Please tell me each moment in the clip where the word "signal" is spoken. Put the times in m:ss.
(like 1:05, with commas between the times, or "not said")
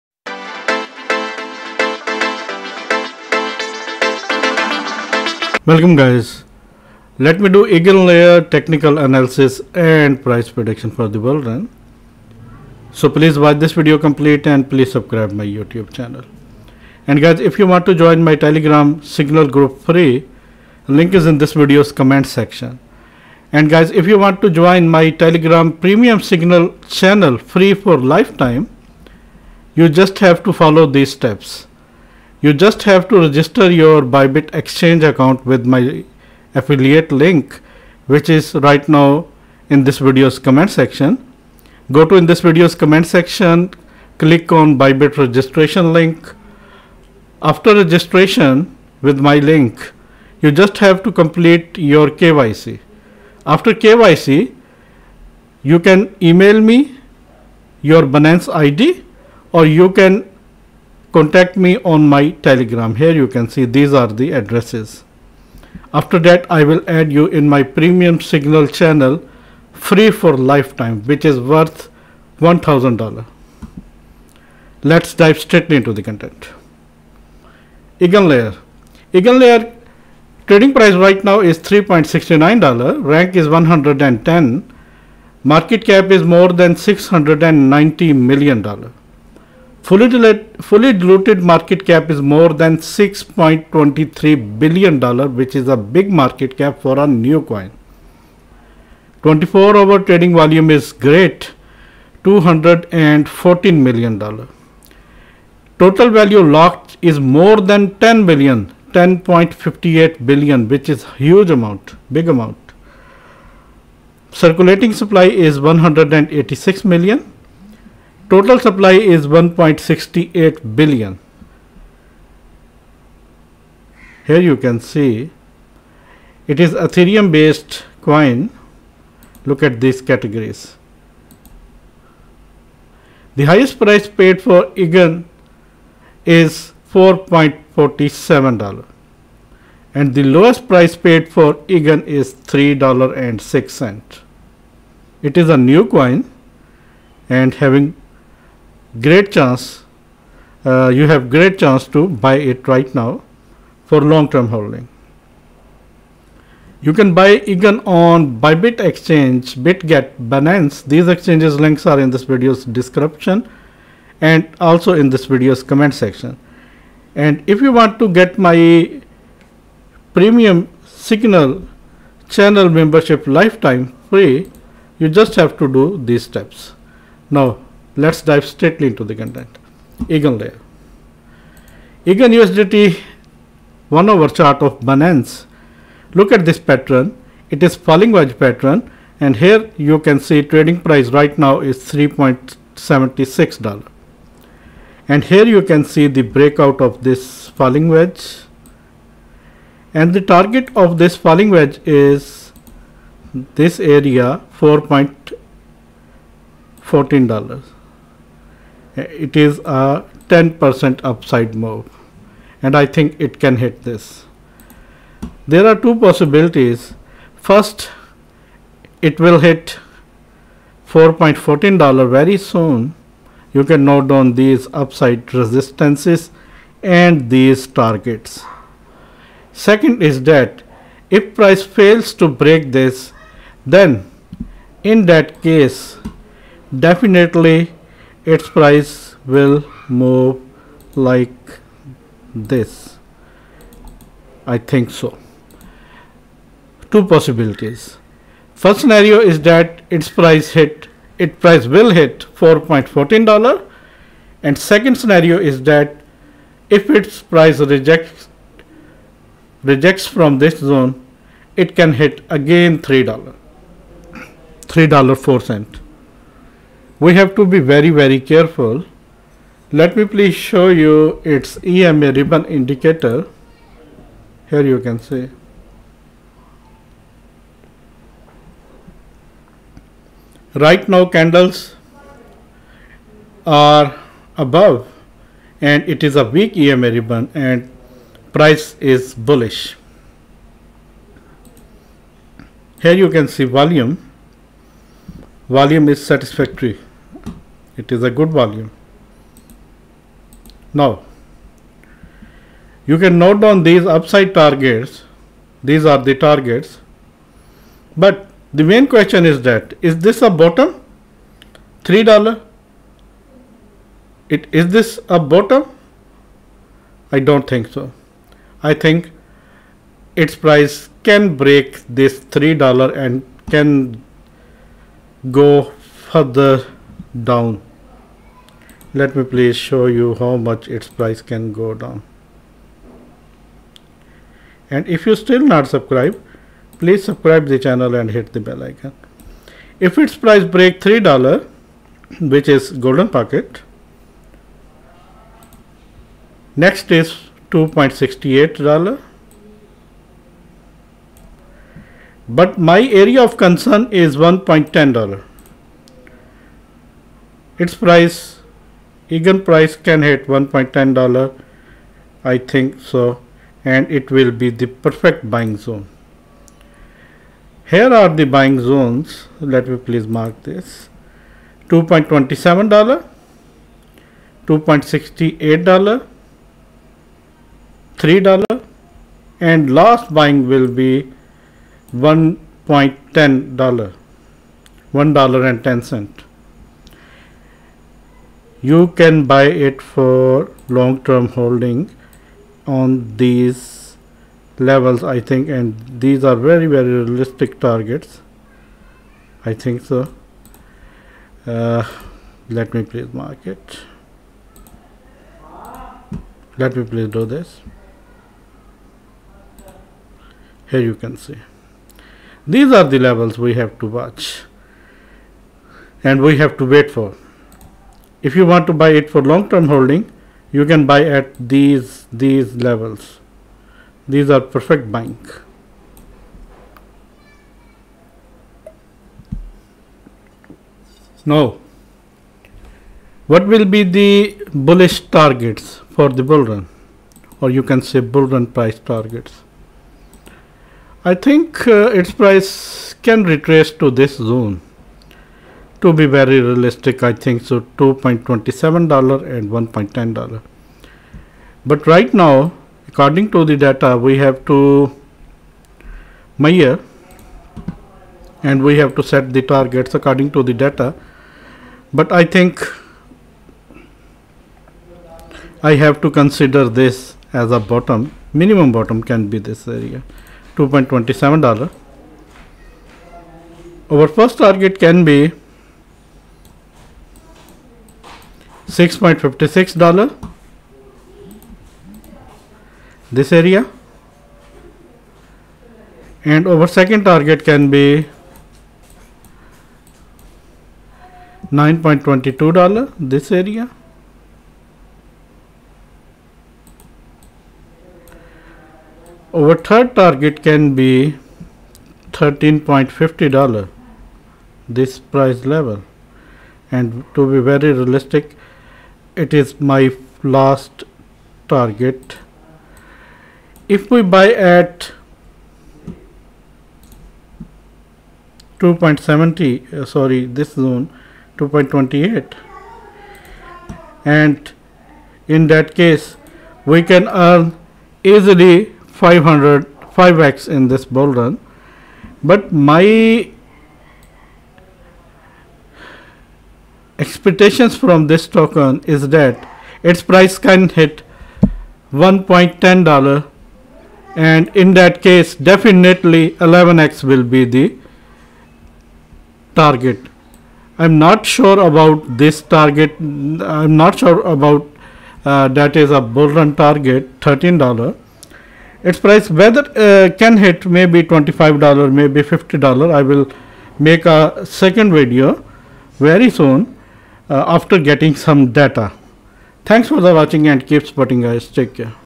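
0:19, 0:26, 1:08, 2:50.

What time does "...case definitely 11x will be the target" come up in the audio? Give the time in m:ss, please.
9:05.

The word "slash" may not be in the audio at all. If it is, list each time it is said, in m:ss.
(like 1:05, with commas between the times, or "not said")
not said.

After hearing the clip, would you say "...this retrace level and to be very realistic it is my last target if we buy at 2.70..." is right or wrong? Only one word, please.
wrong.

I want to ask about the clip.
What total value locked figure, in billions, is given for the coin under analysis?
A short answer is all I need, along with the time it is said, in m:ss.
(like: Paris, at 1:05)
10.58 billion, at 1:48.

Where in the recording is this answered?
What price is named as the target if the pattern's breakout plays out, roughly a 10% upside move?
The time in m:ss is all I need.
3:24.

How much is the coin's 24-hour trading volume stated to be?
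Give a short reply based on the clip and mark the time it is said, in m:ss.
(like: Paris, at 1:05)
$214 million, at 1:42.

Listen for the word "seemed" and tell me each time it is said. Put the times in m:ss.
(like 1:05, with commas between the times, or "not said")
not said.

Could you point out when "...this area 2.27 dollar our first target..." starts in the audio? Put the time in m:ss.
7:49.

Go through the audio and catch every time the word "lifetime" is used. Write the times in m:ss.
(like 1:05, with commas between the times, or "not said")
0:27, 1:10, 2:53.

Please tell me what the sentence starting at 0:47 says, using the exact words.
After registration with my link, you just have to complete your KYC.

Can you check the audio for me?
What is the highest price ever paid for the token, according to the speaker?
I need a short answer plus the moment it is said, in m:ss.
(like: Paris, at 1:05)
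$4.47, at 2:16.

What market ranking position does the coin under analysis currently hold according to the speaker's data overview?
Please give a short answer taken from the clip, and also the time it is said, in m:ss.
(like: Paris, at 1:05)
110, at 1:23.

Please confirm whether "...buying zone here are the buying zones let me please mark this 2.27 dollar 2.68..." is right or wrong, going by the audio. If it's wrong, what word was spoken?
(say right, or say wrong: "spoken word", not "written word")
right.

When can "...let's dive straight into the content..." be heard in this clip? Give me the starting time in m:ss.
1:14.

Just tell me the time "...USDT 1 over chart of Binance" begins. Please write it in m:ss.
3:02.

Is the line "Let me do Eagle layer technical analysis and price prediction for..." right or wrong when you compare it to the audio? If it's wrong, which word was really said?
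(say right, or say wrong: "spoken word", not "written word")
right.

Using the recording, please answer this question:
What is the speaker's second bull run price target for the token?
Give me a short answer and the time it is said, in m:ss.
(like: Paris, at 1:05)
$9.22, at 8:11.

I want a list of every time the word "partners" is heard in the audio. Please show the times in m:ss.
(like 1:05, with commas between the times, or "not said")
not said.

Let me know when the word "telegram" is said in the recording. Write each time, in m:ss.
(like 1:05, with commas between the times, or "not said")
0:18, 0:25, 1:02.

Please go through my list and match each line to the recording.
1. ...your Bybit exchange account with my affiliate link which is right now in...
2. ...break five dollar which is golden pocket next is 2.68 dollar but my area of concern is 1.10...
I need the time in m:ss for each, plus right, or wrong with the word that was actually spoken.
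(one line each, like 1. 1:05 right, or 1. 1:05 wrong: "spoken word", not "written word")
1. 0:33 right
2. 5:40 wrong: "three", not "five".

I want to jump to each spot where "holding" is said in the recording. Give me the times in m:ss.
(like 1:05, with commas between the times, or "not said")
2:34, 6:31, 6:59.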